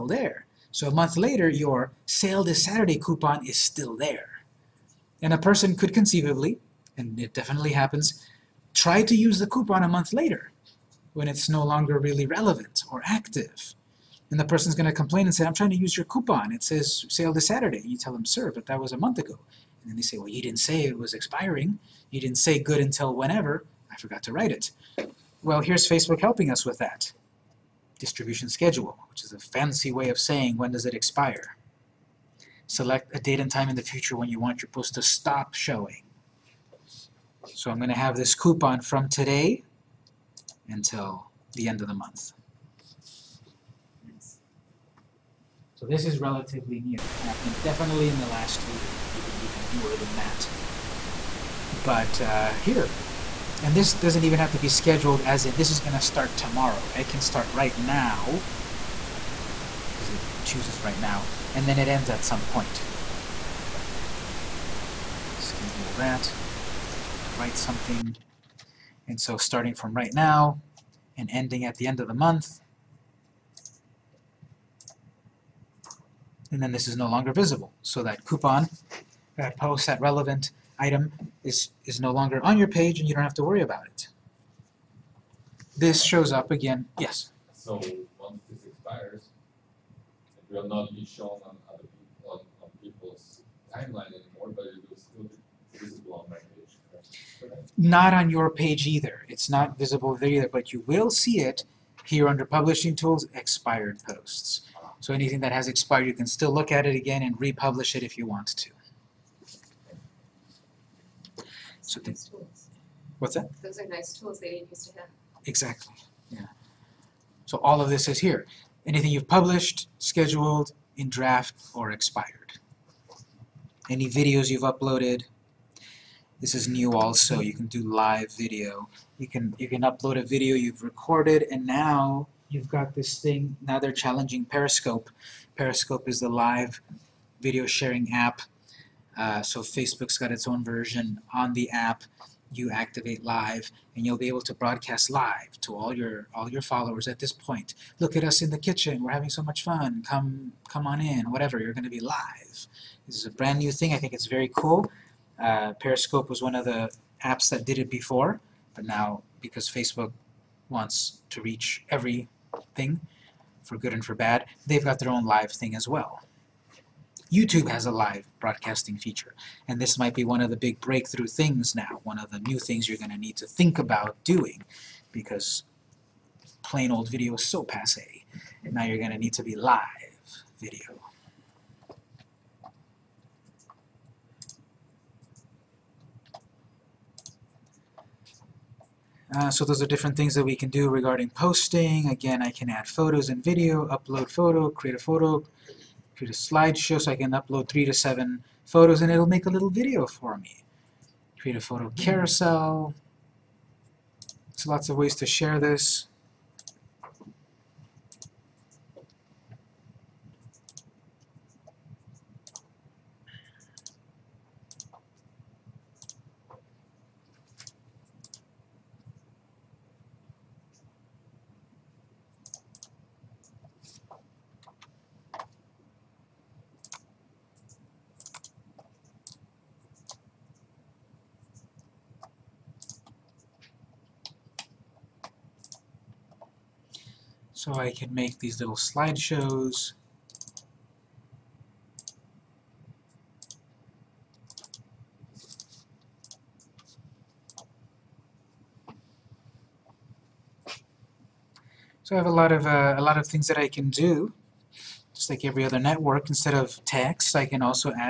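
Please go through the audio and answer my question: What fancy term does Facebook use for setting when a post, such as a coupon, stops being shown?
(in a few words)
distribution schedule.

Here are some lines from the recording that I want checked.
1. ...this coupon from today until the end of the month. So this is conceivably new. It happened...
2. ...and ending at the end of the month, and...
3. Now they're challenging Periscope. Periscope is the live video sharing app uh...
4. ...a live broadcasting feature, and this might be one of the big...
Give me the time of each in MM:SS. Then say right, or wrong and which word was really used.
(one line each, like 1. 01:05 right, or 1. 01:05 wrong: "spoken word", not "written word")
1. 00:38 wrong: "relatively", not "conceivably"
2. 01:11 right
3. 02:13 right
4. 02:47 right.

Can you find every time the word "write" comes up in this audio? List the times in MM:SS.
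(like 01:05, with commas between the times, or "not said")
00:24, 01:07.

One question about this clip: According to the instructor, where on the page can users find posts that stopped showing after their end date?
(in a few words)
Publishing Tools.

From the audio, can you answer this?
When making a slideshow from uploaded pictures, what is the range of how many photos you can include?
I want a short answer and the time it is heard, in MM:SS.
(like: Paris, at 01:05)
3 to 7, at 03:17.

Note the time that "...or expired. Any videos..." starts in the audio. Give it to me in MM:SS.
02:01.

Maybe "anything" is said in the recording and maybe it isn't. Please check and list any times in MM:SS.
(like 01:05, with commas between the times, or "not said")
01:45, 01:58.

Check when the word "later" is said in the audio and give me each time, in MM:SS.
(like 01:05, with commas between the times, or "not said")
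00:01, 00:10.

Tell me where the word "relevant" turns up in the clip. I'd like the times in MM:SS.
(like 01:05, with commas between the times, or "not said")
00:12, 01:20.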